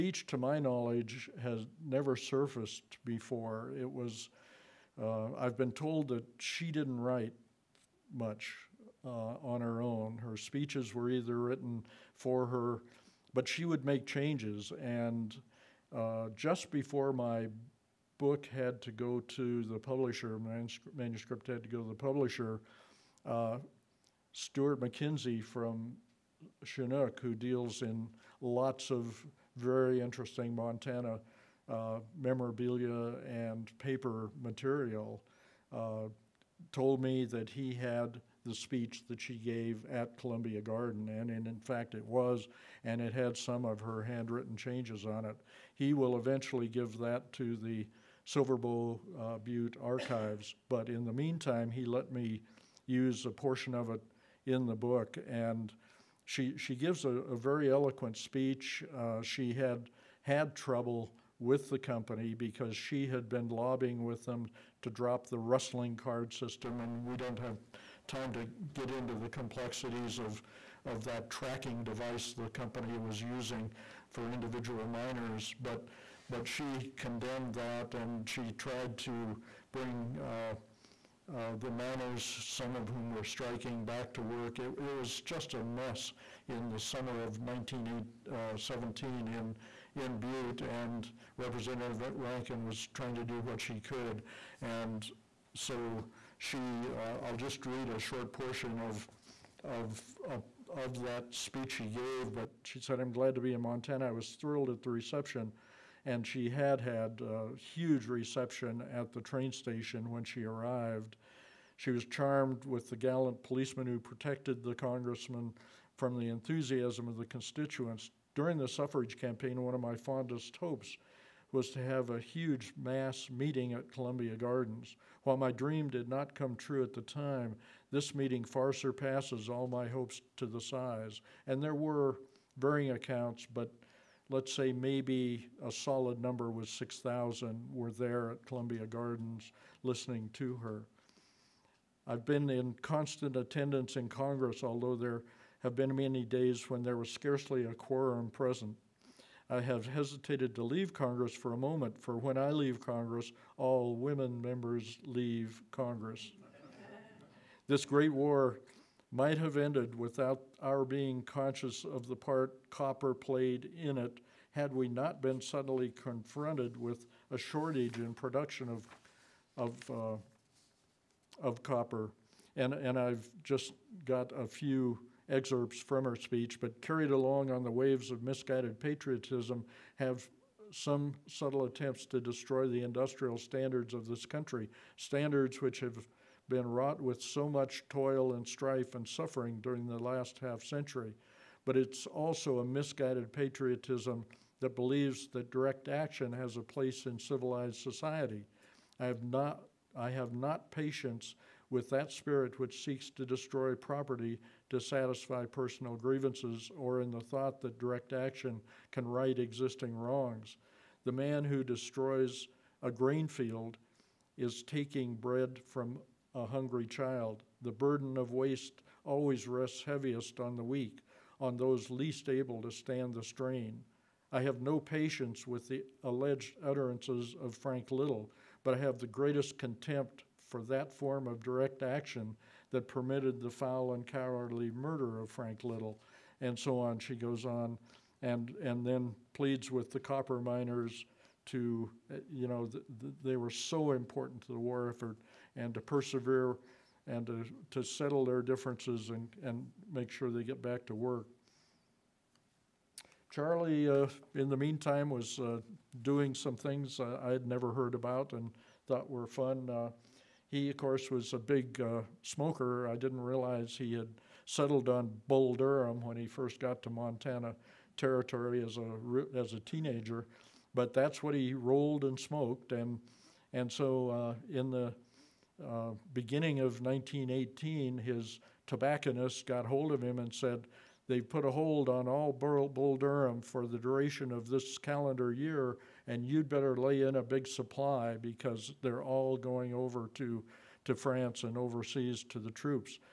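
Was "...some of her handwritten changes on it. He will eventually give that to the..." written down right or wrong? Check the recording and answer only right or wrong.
right.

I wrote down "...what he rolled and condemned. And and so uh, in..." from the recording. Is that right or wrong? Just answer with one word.
wrong.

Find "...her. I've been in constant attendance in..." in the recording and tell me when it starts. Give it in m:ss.
2:20.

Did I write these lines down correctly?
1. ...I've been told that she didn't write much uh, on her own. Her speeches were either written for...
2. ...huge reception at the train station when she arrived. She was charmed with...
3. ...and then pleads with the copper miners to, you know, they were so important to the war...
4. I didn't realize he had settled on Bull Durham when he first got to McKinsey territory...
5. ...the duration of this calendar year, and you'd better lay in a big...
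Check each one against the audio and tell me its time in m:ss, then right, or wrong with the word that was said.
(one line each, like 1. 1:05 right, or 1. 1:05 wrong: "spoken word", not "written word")
1. 0:05 right
2. 1:47 right
3. 3:58 right
4. 4:22 wrong: "Montana", not "McKinsey"
5. 4:43 right.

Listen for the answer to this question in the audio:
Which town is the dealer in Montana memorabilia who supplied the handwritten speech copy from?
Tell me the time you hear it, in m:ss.
0:26.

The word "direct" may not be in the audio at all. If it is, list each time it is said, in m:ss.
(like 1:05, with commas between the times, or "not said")
3:15, 3:27, 3:51.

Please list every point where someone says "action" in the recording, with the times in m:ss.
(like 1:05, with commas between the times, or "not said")
3:15, 3:28, 3:51.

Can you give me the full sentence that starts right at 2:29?
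I have hesitated to leave Congress for a moment, for when I leave Congress, all women members leave Congress.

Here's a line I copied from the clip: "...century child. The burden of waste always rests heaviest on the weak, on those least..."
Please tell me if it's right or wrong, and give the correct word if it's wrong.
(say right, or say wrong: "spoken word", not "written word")
wrong: "hungry", not "century".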